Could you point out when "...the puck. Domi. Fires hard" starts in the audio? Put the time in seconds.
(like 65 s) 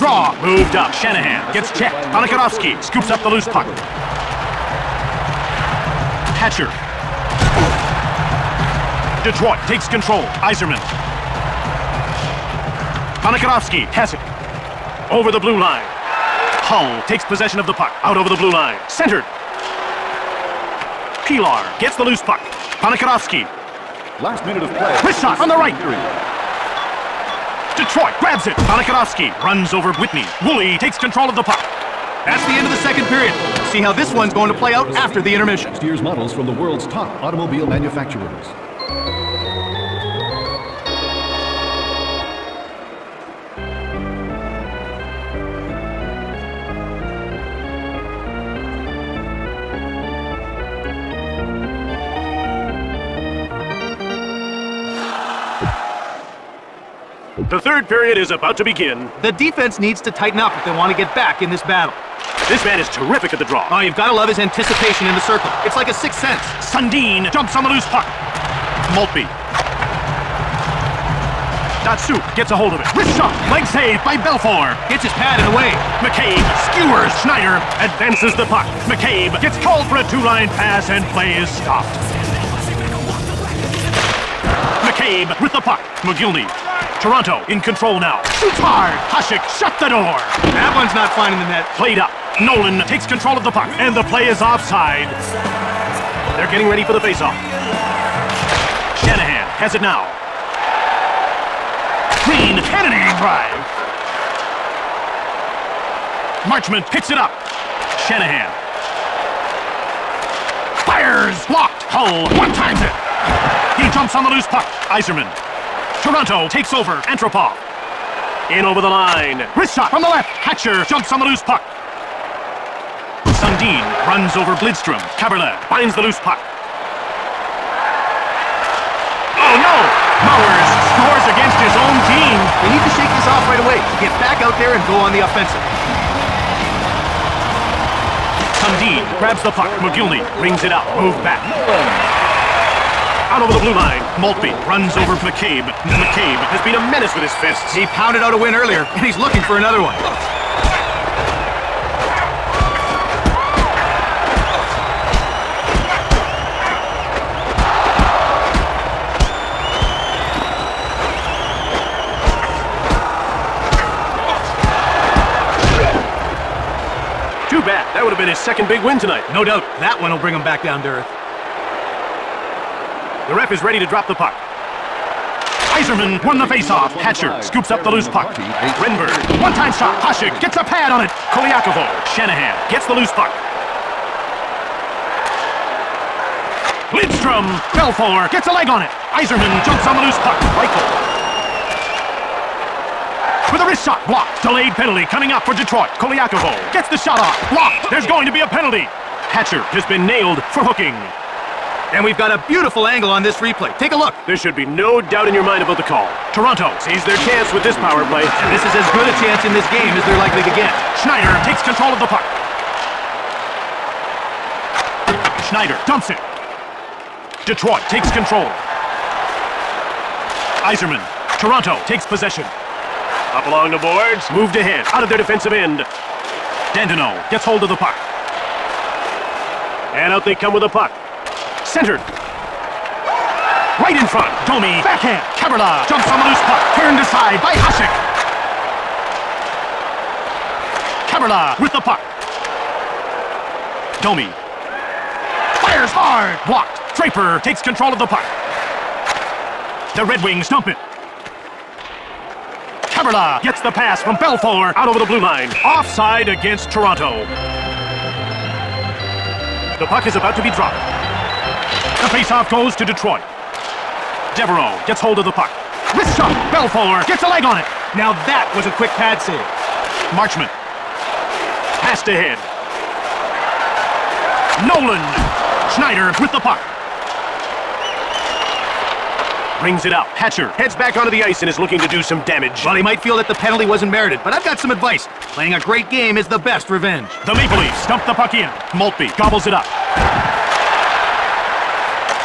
241 s.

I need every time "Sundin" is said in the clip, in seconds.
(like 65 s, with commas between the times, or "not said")
66 s, 138 s.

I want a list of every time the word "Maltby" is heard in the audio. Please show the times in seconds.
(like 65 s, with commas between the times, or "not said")
68 s, 144 s, 288 s.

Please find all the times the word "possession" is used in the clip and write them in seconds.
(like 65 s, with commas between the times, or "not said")
17 s, 222 s.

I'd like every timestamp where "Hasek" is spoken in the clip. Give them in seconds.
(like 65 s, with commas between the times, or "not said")
89 s, 180 s, 237 s.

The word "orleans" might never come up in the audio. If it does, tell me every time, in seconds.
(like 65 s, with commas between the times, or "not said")
not said.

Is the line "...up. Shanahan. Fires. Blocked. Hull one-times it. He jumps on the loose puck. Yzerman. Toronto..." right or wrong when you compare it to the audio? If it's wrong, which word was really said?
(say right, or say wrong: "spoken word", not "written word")
right.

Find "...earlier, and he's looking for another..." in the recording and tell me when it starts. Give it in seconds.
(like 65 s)
148 s.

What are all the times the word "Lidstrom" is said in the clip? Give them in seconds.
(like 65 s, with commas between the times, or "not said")
124 s, 186 s.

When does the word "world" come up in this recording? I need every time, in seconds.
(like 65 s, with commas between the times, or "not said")
36 s.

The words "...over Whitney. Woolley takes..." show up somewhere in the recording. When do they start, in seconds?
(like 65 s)
29 s.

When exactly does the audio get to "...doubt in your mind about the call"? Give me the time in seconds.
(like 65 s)
204 s.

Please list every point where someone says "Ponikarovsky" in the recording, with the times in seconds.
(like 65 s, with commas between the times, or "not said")
2 s, 13 s, 22 s, 28 s.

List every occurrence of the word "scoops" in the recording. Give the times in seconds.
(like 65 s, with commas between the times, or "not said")
2 s, 177 s.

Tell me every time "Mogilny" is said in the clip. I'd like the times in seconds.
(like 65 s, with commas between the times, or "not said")
86 s, 139 s.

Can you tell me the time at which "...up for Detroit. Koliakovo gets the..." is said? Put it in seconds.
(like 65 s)
195 s.